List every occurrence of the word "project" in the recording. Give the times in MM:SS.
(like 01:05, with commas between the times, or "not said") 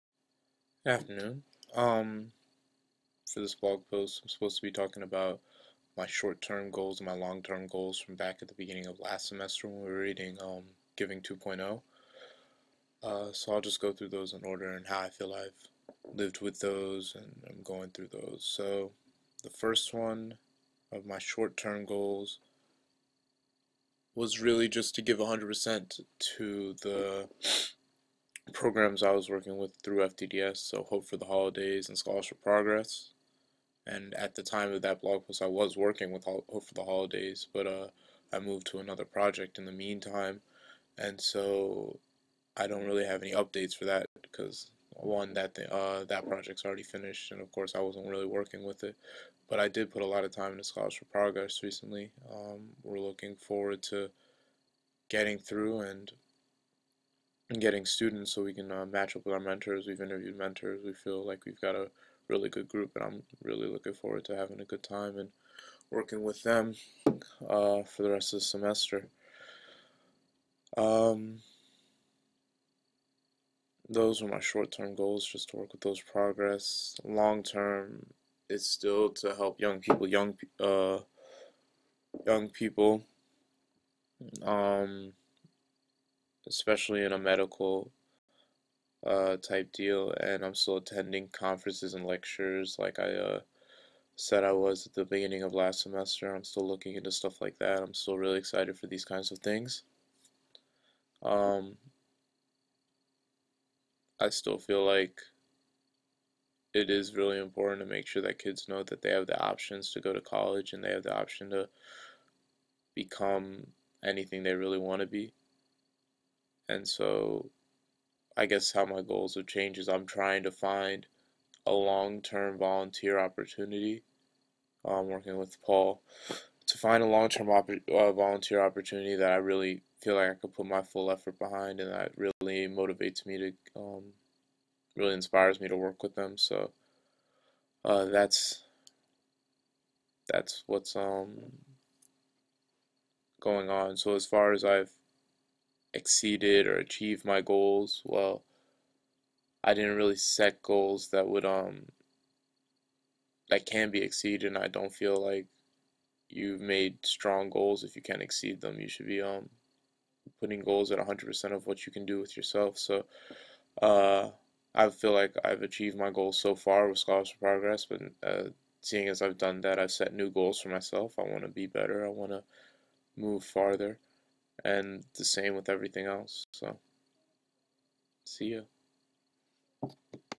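00:39, 00:46.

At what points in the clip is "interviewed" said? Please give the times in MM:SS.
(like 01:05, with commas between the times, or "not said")
01:00.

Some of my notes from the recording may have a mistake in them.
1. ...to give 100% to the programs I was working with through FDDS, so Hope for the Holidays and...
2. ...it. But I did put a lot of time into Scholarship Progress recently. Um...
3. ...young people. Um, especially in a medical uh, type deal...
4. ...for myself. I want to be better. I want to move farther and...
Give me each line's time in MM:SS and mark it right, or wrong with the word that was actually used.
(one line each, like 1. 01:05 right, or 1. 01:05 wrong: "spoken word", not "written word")
1. 00:24 right
2. 00:48 right
3. 01:22 right
4. 02:50 right.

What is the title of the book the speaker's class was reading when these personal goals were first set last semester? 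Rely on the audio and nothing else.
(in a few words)
Giving 2.0.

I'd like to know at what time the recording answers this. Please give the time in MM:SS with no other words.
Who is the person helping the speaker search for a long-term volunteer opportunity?
02:05.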